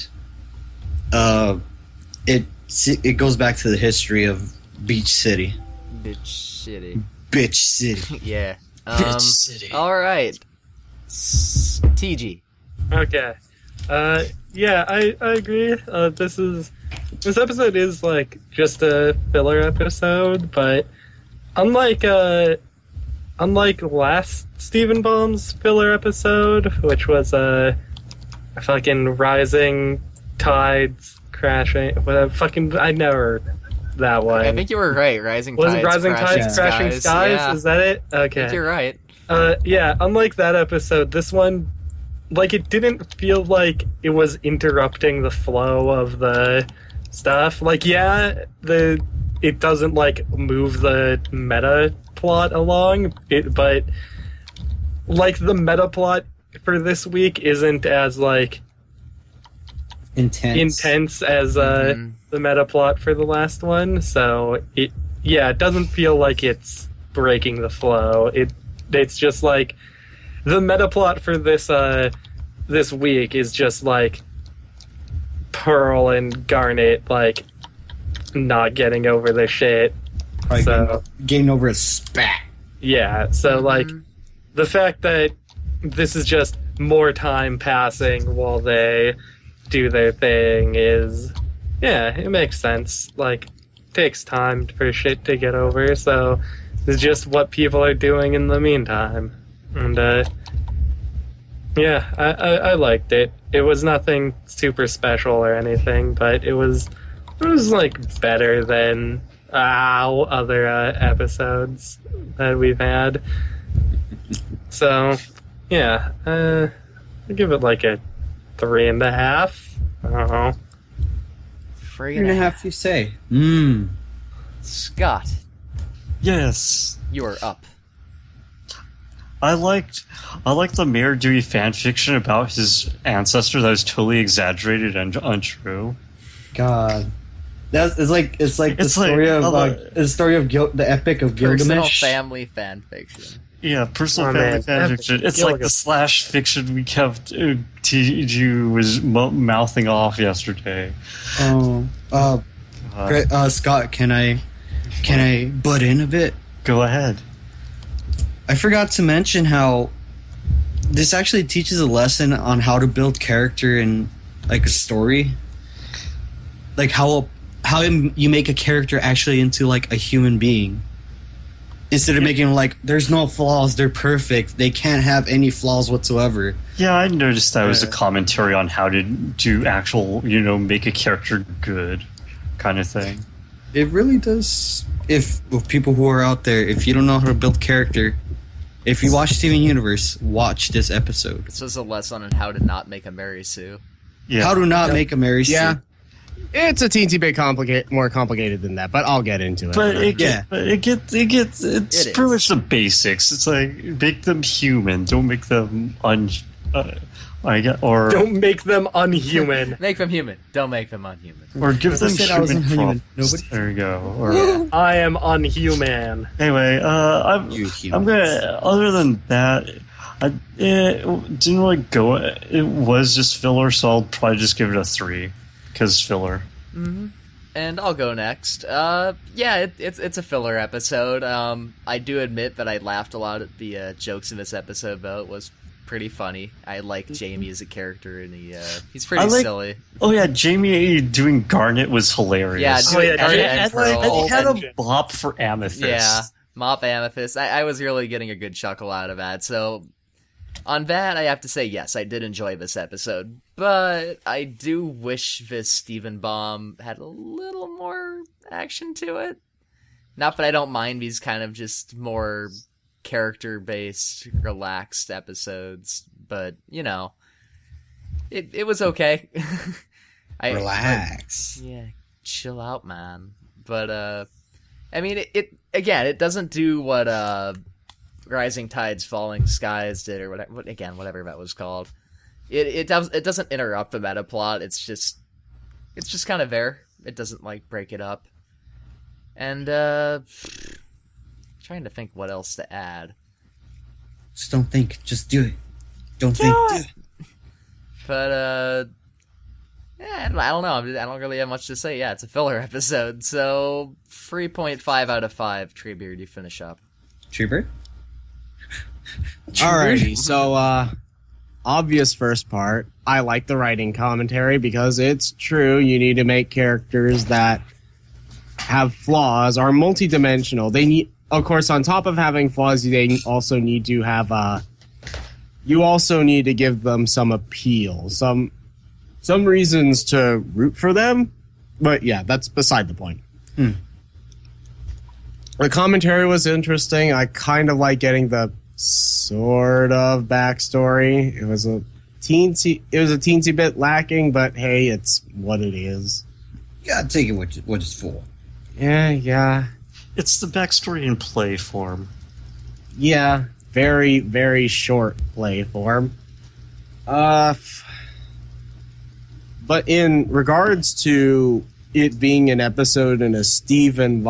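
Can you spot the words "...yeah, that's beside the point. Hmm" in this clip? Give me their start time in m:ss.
5:32.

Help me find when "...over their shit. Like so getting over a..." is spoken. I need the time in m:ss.
1:19.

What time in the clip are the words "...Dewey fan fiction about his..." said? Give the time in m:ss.
2:11.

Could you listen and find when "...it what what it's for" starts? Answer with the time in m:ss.
5:47.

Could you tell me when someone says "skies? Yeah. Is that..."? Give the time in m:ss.
0:37.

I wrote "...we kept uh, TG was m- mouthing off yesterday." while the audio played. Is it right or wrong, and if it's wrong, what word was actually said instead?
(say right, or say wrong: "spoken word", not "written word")
right.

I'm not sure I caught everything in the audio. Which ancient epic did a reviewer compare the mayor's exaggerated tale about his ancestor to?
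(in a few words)
Epic of Gilgamesh.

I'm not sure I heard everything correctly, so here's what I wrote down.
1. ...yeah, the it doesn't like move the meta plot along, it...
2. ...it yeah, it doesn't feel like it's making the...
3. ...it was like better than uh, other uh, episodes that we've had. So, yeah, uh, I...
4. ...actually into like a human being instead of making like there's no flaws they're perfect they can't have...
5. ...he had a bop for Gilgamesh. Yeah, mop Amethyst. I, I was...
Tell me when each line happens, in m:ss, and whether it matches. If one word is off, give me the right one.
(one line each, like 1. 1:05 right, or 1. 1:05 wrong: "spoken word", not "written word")
1. 0:47 right
2. 1:04 wrong: "breaking", not "making"
3. 1:47 right
4. 2:48 right
5. 4:04 wrong: "Amethyst", not "Gilgamesh".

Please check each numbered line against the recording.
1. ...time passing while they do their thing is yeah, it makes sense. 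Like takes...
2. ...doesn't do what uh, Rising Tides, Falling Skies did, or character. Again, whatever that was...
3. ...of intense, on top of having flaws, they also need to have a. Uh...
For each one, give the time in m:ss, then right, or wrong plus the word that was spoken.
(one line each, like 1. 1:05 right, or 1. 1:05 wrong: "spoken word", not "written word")
1. 1:27 right
2. 4:36 wrong: "whatever", not "character"
3. 5:21 wrong: "course", not "intense".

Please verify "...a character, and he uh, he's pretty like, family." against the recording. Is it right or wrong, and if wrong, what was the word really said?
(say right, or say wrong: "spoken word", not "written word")
wrong: "silly", not "family".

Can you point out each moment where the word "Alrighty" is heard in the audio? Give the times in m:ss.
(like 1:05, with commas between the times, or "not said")
5:09.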